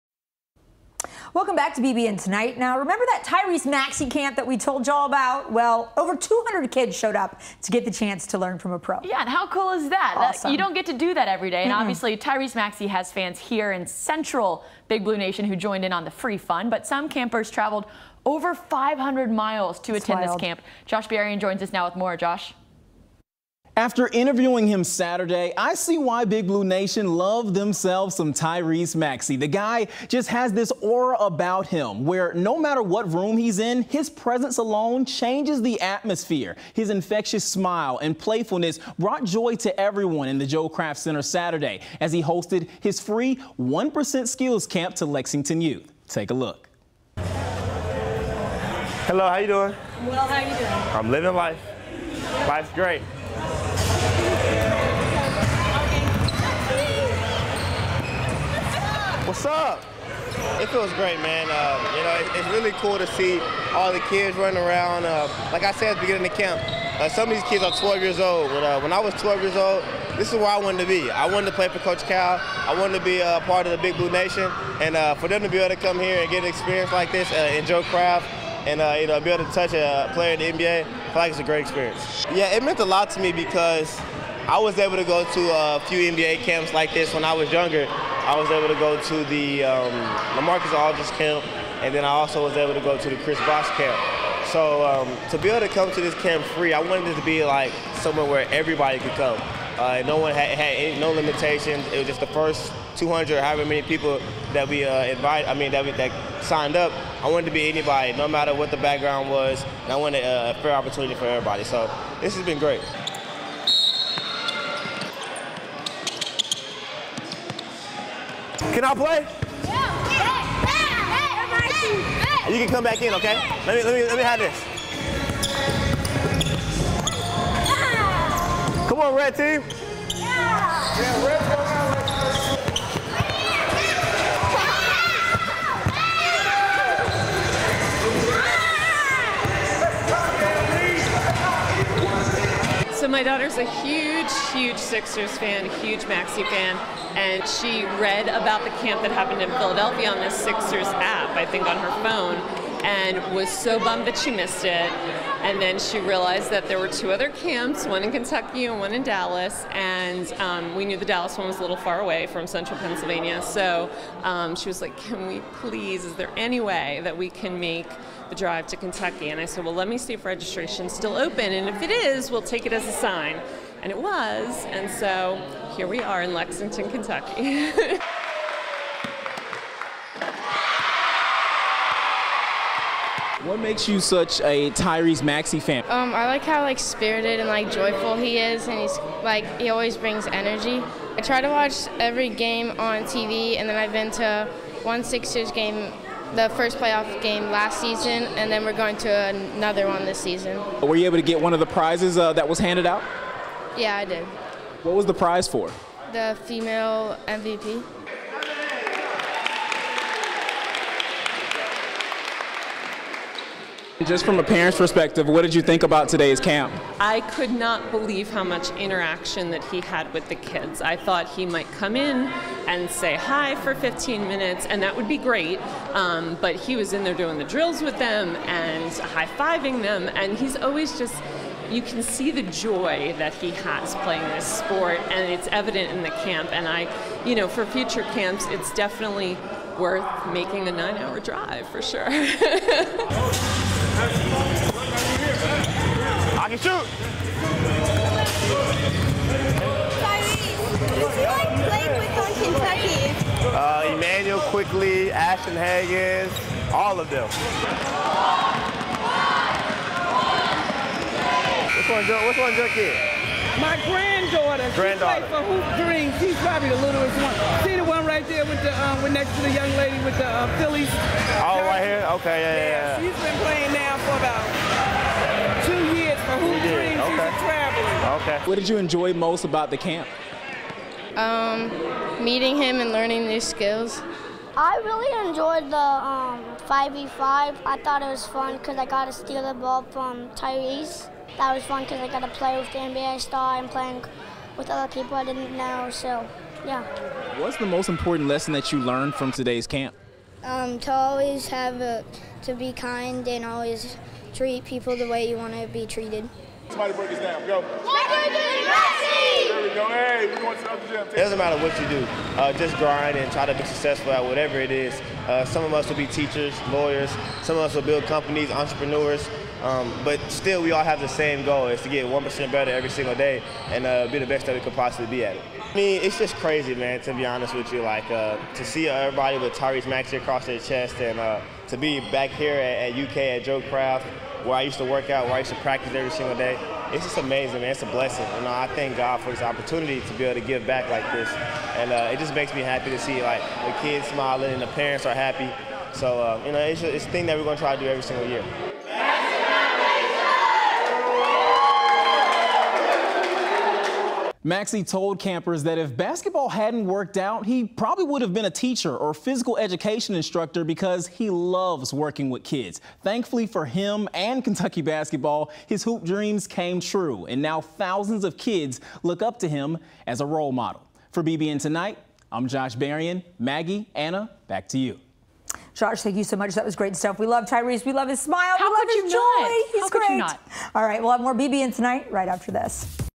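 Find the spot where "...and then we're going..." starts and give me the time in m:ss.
3:18.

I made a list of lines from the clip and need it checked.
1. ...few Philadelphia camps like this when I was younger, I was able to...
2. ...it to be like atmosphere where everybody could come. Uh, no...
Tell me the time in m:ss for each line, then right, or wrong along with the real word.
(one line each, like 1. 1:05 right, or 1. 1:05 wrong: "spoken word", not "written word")
1. 1:25 wrong: "NBA", not "Philadelphia"
2. 1:37 wrong: "somewhere", not "atmosphere".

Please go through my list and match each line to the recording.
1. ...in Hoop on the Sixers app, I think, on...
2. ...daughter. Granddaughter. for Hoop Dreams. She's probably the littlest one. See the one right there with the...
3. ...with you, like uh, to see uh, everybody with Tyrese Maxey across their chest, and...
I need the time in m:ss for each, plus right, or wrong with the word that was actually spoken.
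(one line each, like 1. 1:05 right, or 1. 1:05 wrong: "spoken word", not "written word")
1. 2:29 wrong: "Philadelphia", not "Hoop"
2. 4:24 right
3. 5:27 right.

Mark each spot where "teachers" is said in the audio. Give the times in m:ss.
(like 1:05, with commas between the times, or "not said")
5:16, 5:58.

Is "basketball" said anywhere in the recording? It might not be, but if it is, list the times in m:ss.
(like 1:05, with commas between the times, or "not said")
5:55, 6:04.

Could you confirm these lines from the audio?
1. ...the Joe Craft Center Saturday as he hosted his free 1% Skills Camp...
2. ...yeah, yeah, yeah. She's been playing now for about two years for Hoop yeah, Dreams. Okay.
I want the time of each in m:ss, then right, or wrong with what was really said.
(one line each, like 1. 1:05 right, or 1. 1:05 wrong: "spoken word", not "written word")
1. 0:40 right
2. 4:32 right.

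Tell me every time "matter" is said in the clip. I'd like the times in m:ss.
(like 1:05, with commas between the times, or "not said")
0:32, 1:48, 5:11.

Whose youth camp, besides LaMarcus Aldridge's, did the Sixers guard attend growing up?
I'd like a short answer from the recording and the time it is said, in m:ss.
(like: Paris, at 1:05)
Chris Bosh, at 1:33.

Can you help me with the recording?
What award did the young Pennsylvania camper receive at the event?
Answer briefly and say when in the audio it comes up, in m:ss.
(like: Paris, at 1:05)
Female MVP, at 3:26.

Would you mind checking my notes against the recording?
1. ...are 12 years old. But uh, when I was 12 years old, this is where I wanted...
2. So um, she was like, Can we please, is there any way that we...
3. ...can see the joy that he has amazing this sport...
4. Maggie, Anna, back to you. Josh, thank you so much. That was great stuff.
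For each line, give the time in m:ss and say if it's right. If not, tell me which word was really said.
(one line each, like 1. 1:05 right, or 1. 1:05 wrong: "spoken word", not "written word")
1. 1:07 right
2. 2:43 right
3. 3:51 wrong: "playing", not "amazing"
4. 6:13 right.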